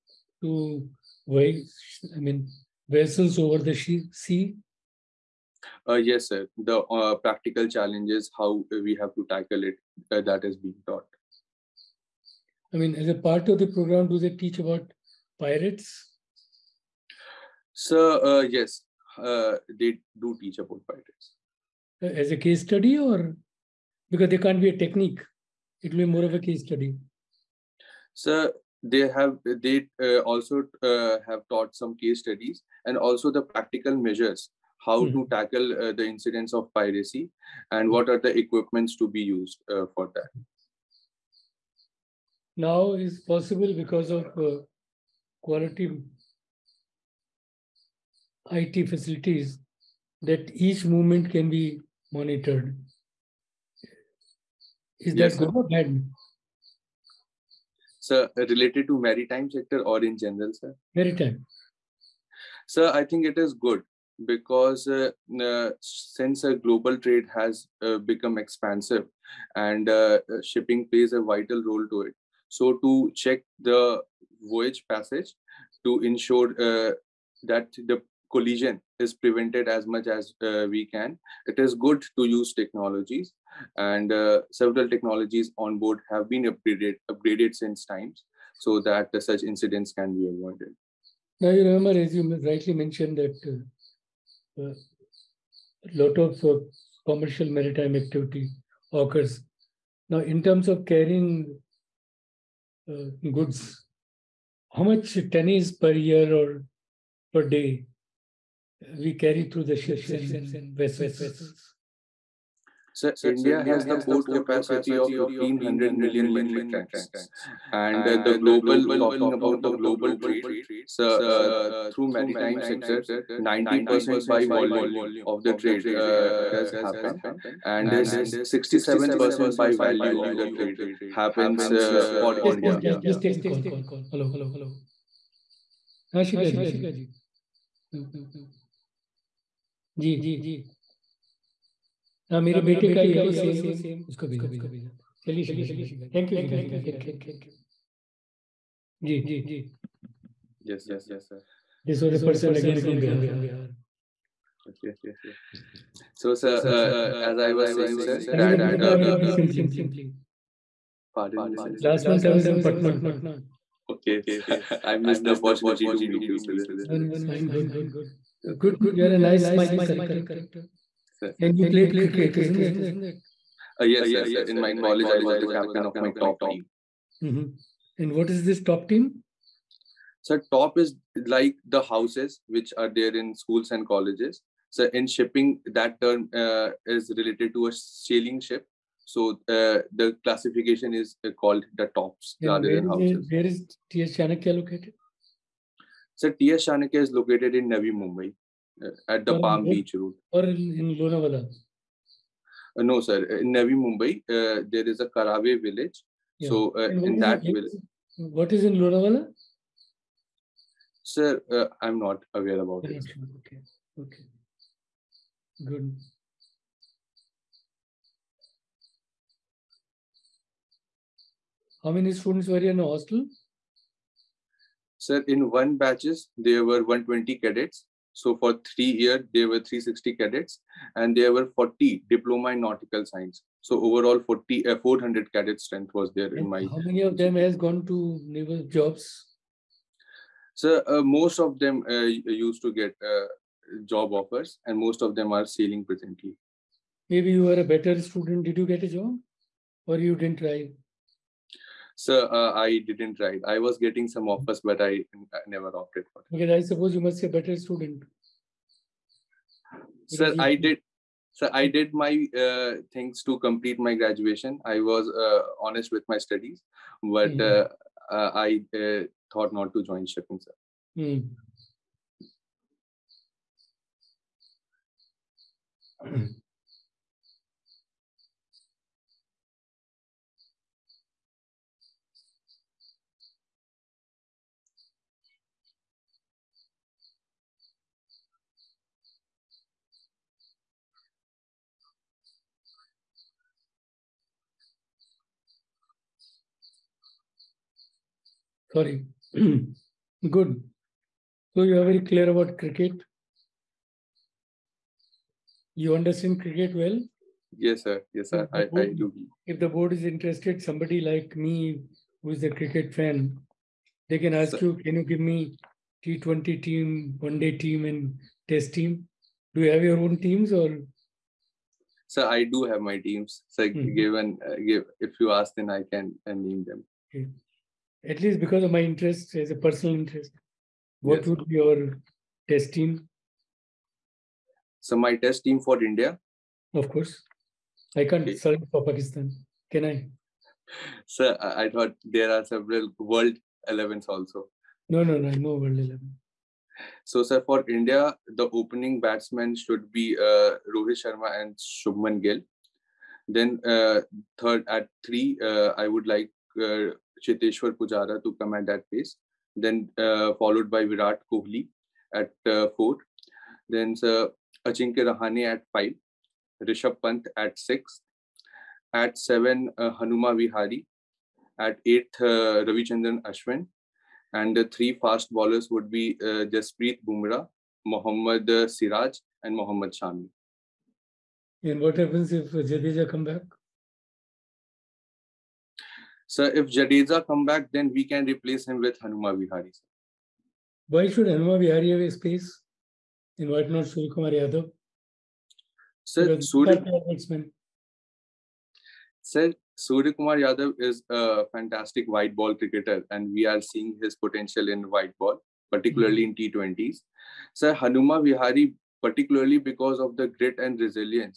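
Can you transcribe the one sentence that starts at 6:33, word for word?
And why not Surya Kumar Yadav?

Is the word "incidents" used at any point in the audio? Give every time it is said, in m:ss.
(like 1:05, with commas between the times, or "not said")
0:36, 1:29.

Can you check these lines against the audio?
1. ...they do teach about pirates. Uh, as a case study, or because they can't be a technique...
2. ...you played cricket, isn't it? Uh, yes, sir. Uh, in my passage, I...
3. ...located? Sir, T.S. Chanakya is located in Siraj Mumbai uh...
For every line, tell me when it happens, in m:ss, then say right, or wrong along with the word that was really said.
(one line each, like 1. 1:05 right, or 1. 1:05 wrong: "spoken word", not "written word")
1. 0:19 right
2. 2:51 wrong: "college", not "passage"
3. 3:14 wrong: "Navi", not "Siraj".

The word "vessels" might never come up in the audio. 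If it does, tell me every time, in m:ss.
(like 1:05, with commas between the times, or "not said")
0:02, 1:50.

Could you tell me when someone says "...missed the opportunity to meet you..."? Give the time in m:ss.
2:45.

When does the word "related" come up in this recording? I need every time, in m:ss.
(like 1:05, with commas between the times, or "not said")
0:58, 3:07.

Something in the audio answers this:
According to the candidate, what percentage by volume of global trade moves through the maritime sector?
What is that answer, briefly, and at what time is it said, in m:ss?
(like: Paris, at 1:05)
90%, at 2:03.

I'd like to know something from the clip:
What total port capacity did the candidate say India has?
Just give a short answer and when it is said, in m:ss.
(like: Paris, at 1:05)
1500 million metric tons, at 1:55.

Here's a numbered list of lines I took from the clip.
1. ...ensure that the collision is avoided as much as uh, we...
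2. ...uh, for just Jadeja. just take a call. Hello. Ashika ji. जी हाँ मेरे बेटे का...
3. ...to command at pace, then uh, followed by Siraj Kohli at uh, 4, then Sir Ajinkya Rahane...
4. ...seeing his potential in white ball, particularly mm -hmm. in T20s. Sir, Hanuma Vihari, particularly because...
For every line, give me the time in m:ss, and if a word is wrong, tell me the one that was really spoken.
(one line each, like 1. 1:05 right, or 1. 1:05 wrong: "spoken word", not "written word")
1. 1:16 wrong: "prevented", not "avoided"
2. 2:11 wrong: "India", not "Jadeja"
3. 5:58 wrong: "Virat", not "Siraj"
4. 6:43 right.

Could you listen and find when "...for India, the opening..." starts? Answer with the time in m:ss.
5:47.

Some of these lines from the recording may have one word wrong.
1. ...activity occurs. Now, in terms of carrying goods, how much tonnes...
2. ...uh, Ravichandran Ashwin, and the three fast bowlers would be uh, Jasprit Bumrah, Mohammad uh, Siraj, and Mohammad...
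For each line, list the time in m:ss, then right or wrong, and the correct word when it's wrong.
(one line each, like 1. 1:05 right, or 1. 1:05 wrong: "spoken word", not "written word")
1. 1:37 right
2. 6:12 right.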